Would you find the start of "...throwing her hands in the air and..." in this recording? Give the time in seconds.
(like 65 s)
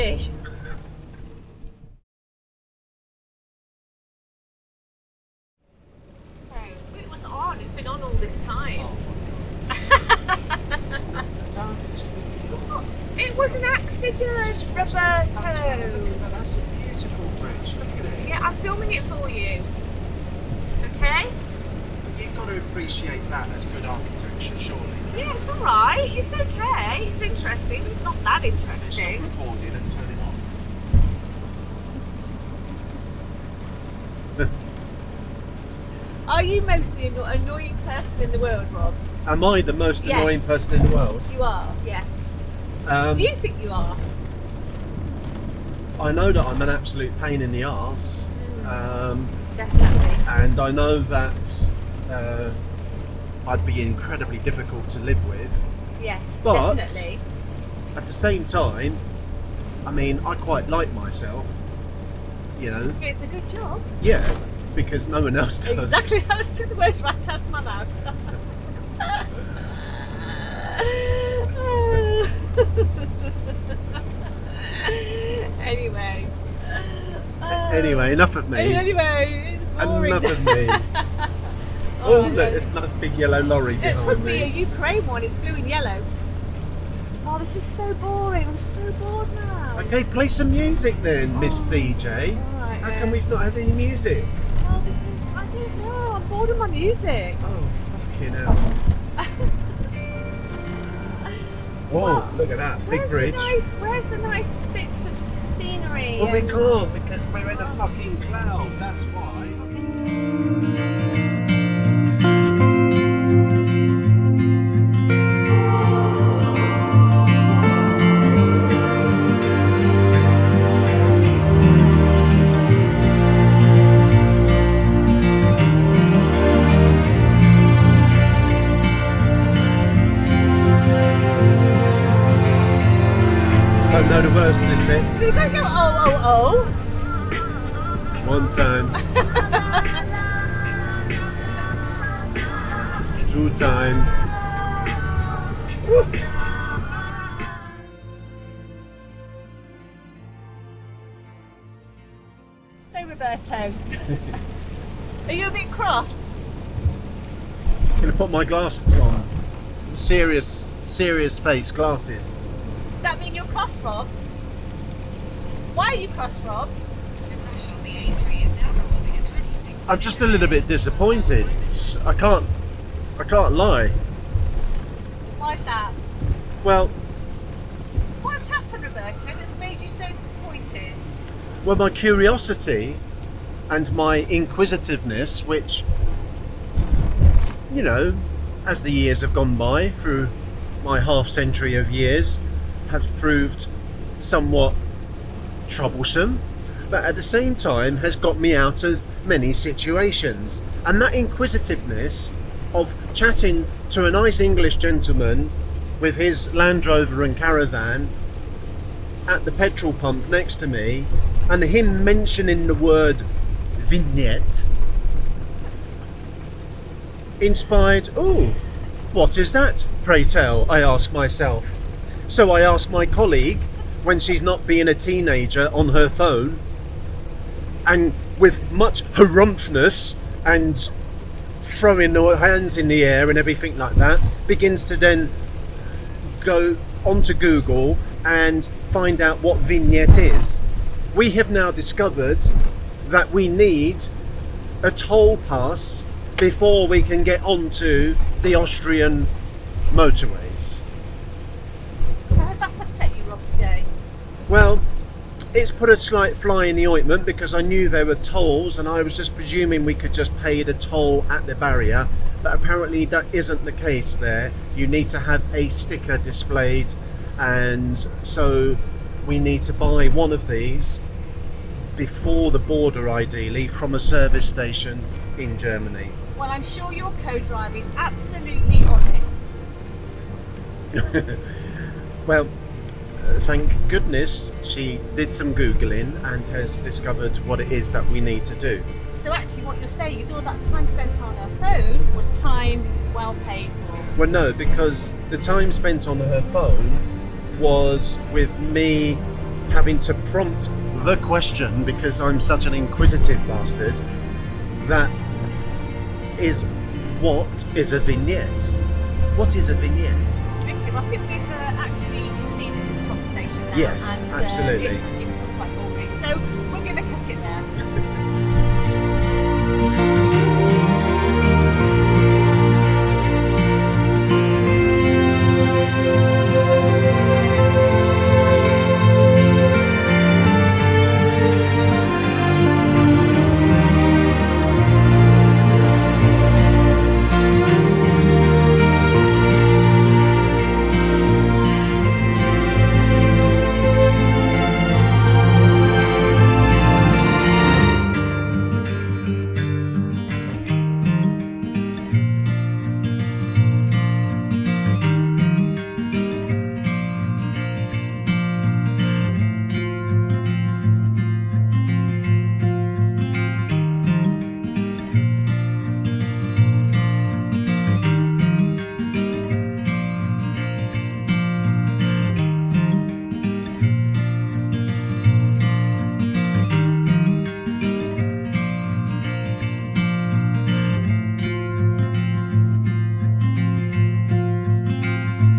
231 s.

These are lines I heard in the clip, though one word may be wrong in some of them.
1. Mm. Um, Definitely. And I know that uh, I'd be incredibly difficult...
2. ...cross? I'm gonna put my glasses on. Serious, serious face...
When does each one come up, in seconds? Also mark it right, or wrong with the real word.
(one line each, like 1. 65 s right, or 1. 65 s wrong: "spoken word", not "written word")
1. 48 s right
2. 155 s right.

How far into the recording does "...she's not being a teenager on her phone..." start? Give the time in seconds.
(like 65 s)
224 s.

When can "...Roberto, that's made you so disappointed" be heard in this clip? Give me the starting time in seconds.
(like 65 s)
178 s.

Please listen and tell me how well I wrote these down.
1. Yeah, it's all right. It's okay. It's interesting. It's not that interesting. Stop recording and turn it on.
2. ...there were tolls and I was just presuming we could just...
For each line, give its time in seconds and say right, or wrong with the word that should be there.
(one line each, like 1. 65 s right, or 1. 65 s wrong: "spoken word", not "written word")
1. 25 s right
2. 257 s right.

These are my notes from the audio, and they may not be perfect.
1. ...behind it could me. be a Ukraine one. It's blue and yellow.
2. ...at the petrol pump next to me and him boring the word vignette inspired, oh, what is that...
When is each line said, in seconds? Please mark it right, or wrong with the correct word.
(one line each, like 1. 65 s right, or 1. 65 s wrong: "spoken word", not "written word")
1. 83 s right
2. 209 s wrong: "mentioning", not "boring".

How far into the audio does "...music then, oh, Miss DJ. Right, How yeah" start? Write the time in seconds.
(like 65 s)
90 s.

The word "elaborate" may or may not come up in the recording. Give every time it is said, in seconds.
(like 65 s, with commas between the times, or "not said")
not said.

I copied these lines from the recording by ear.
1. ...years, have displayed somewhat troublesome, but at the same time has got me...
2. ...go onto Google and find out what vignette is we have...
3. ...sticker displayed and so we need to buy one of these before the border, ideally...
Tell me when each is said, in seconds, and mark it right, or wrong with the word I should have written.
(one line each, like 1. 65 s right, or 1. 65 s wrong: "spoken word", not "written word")
1. 191 s wrong: "proved", not "displayed"
2. 236 s right
3. 265 s right.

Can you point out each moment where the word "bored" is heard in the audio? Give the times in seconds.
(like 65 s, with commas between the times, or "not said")
88 s, 96 s.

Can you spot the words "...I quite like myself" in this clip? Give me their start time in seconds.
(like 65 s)
60 s.